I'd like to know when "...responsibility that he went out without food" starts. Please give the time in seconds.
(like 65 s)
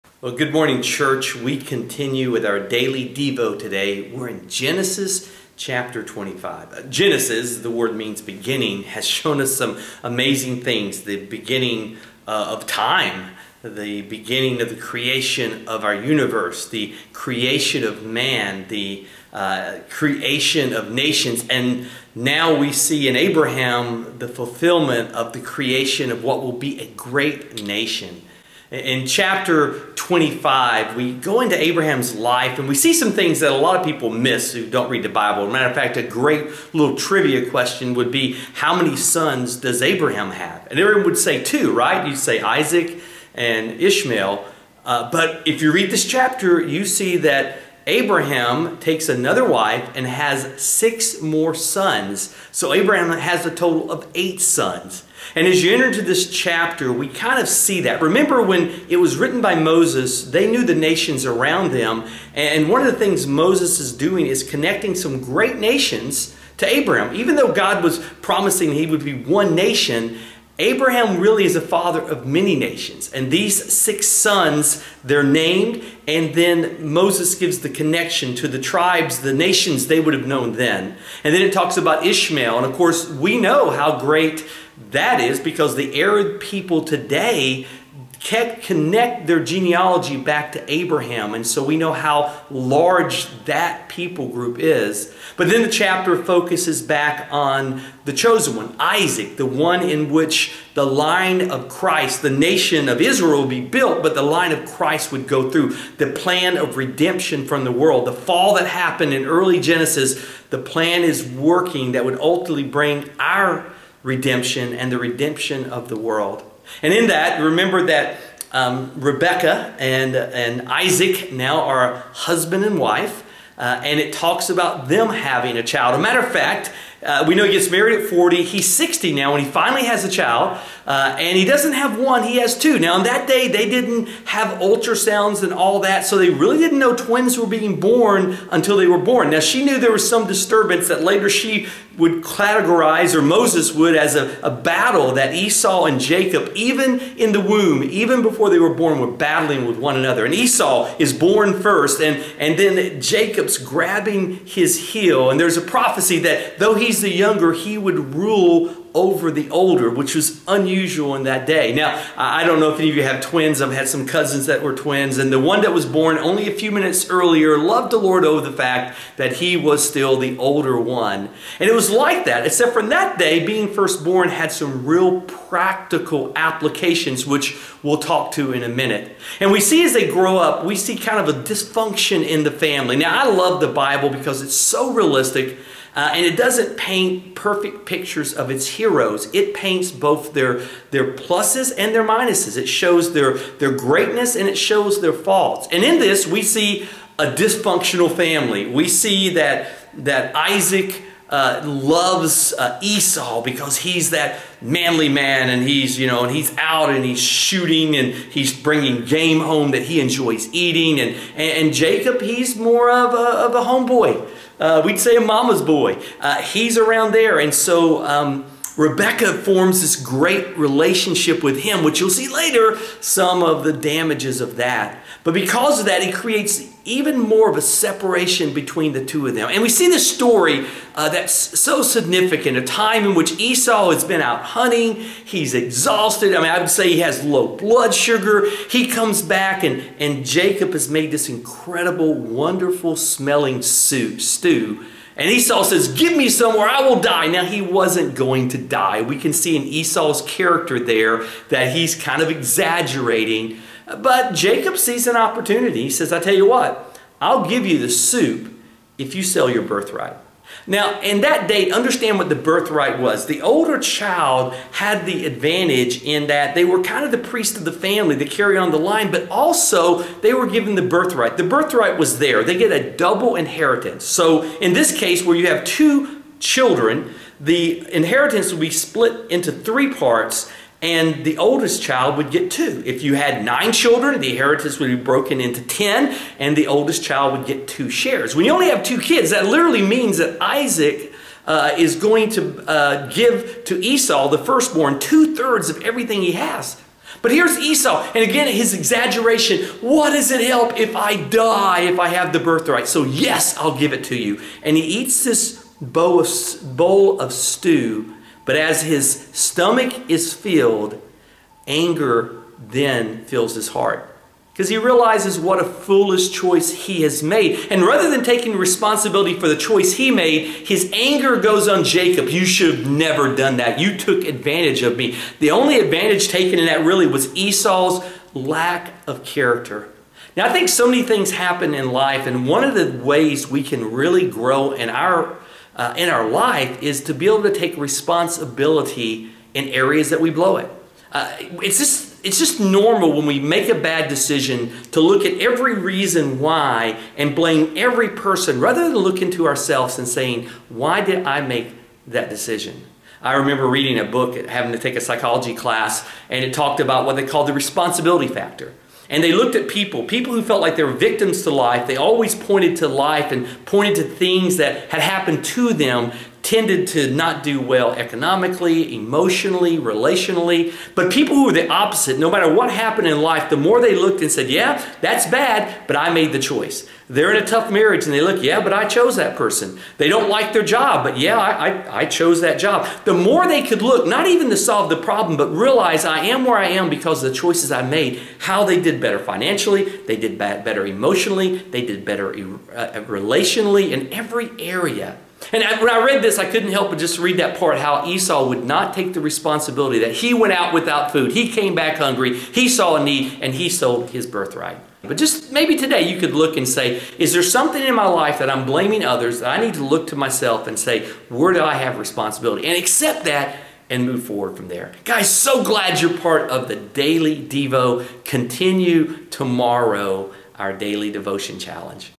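399 s.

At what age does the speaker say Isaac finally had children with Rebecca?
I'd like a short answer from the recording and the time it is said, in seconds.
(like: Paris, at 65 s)
60, at 128 s.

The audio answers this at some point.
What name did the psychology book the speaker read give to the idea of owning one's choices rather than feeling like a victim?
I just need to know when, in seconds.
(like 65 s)
357 s.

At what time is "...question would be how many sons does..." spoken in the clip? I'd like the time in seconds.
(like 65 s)
37 s.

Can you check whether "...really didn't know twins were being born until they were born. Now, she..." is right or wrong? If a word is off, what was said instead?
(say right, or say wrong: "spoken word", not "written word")
right.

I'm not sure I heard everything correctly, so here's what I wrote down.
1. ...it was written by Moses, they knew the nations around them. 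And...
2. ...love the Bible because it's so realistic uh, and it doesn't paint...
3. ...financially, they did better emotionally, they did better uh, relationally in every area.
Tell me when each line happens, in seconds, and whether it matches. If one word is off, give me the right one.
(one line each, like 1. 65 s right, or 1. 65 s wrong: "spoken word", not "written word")
1. 58 s right
2. 183 s right
3. 389 s right.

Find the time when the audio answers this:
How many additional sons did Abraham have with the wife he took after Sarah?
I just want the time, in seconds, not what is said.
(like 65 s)
50 s.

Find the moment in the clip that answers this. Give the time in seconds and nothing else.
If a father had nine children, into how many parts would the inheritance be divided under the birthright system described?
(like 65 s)
284 s.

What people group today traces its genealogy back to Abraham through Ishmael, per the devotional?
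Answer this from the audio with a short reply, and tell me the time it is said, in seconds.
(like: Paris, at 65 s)
The Arab people, at 85 s.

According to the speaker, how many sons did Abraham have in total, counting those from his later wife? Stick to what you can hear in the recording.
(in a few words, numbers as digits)
8.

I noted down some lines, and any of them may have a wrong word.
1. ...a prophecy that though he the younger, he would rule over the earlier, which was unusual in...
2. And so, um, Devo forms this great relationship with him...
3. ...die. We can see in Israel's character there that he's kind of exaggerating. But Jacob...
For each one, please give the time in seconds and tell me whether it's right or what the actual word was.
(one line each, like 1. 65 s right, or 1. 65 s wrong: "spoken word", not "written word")
1. 155 s wrong: "older", not "earlier"
2. 217 s wrong: "Rebecca", not "Devo"
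3. 248 s wrong: "Esau", not "Israel".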